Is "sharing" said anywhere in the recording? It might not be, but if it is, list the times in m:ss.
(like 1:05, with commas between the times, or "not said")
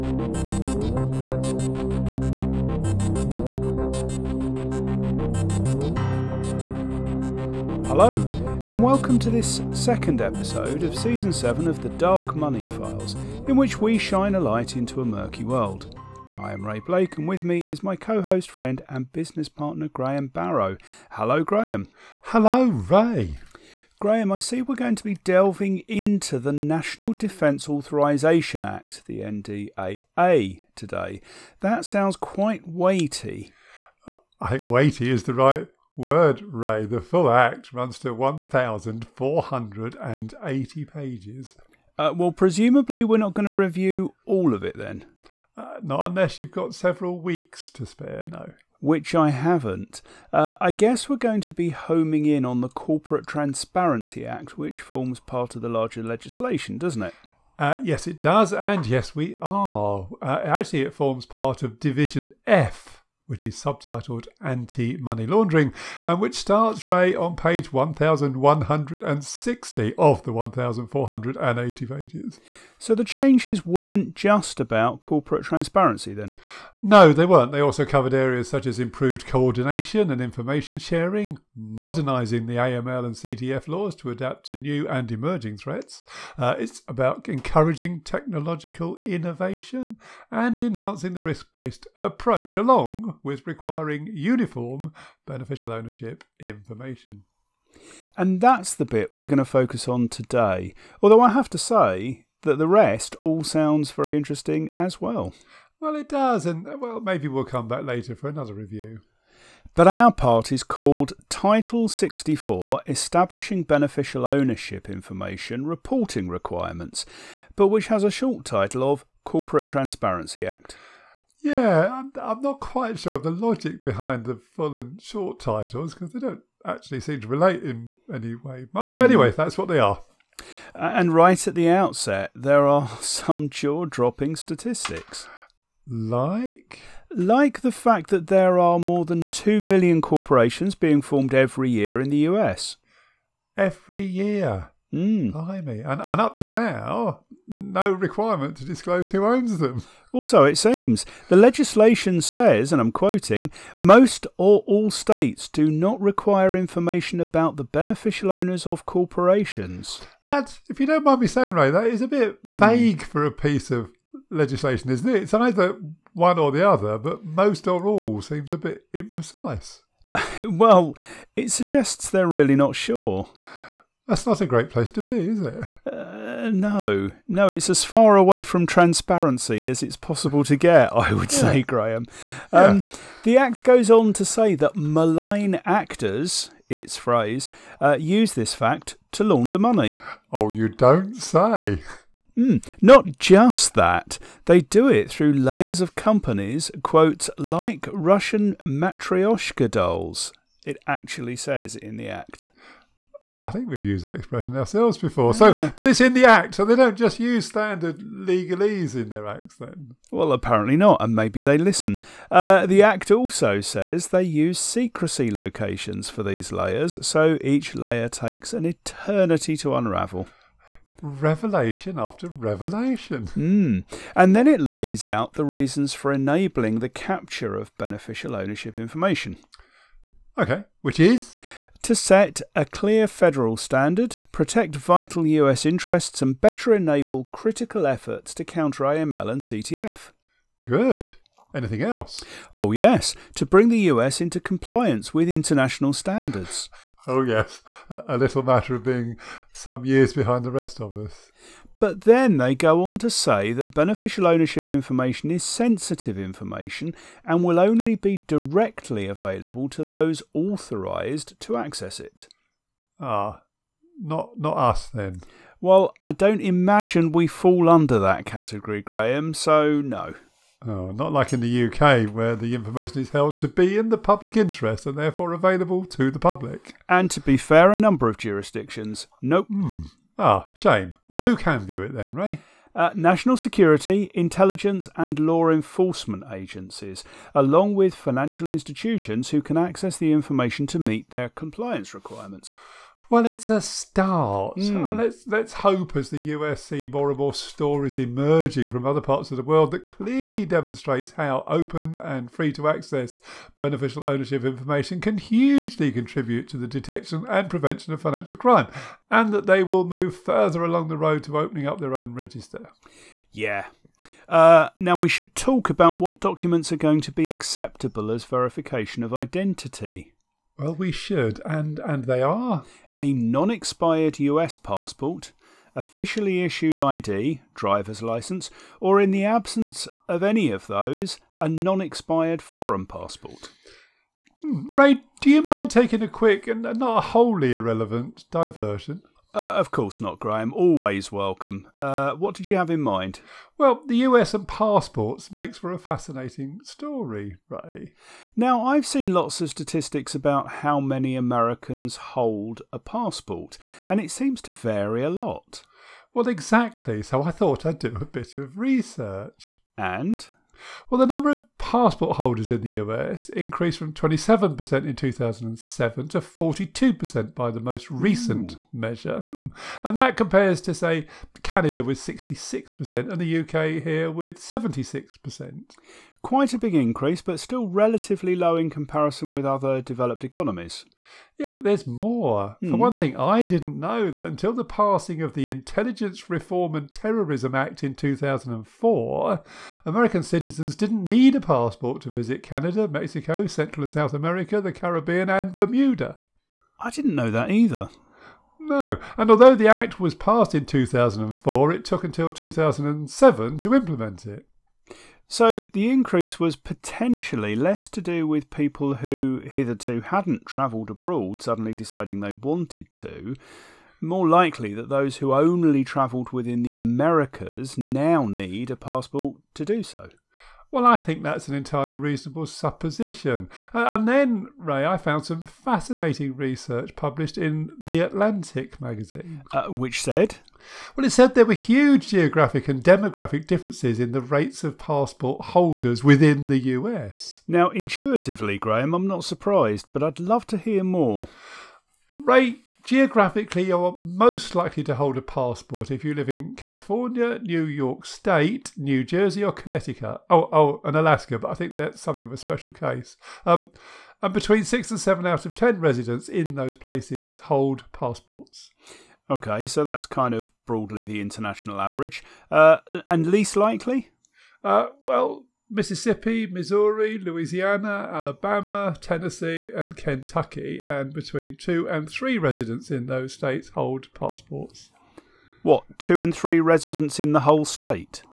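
1:20.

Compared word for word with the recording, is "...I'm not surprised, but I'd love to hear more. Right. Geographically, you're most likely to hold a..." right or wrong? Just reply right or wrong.
right.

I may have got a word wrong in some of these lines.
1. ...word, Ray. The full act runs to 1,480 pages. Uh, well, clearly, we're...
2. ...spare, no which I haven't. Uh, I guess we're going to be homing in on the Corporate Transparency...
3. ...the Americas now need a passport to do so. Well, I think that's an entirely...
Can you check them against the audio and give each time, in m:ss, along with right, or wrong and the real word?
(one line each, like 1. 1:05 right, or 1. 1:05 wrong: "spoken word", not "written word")
1. 0:35 wrong: "presumably", not "clearly"
2. 0:47 right
3. 6:56 right.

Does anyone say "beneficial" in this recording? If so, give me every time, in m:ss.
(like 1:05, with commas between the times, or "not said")
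1:35, 1:53, 2:37, 3:47, 4:13, 5:03.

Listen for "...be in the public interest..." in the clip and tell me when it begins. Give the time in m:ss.
4:33.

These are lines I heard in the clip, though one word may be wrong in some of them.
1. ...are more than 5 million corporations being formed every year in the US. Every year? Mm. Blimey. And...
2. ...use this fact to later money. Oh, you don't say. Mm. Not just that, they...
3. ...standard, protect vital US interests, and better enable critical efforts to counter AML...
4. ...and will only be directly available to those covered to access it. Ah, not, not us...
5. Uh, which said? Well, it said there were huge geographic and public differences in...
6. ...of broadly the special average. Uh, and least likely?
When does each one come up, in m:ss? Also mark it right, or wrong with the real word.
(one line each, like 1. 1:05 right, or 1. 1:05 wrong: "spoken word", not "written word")
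1. 2:18 wrong: "2", not "5"
2. 3:08 wrong: "launder", not "later"
3. 3:53 right
4. 4:17 wrong: "authorised", not "covered"
5. 7:09 wrong: "demographic", not "public"
6. 7:40 wrong: "international", not "special".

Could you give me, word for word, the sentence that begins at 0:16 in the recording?
I am Ray Blake, and with me is my co host, friend, and business partner, Graham Barrow.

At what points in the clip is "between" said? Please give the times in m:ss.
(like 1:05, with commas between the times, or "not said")
7:34, 7:51.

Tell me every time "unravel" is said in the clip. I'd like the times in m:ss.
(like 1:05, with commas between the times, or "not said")
3:39.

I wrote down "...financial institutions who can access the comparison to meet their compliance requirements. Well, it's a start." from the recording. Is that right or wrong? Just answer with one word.
wrong.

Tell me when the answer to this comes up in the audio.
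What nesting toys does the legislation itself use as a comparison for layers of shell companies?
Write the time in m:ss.
3:17.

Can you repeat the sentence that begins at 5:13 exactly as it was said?
Yeah, uh, now, we should talk about what documents are going to be acceptable as verification of identity.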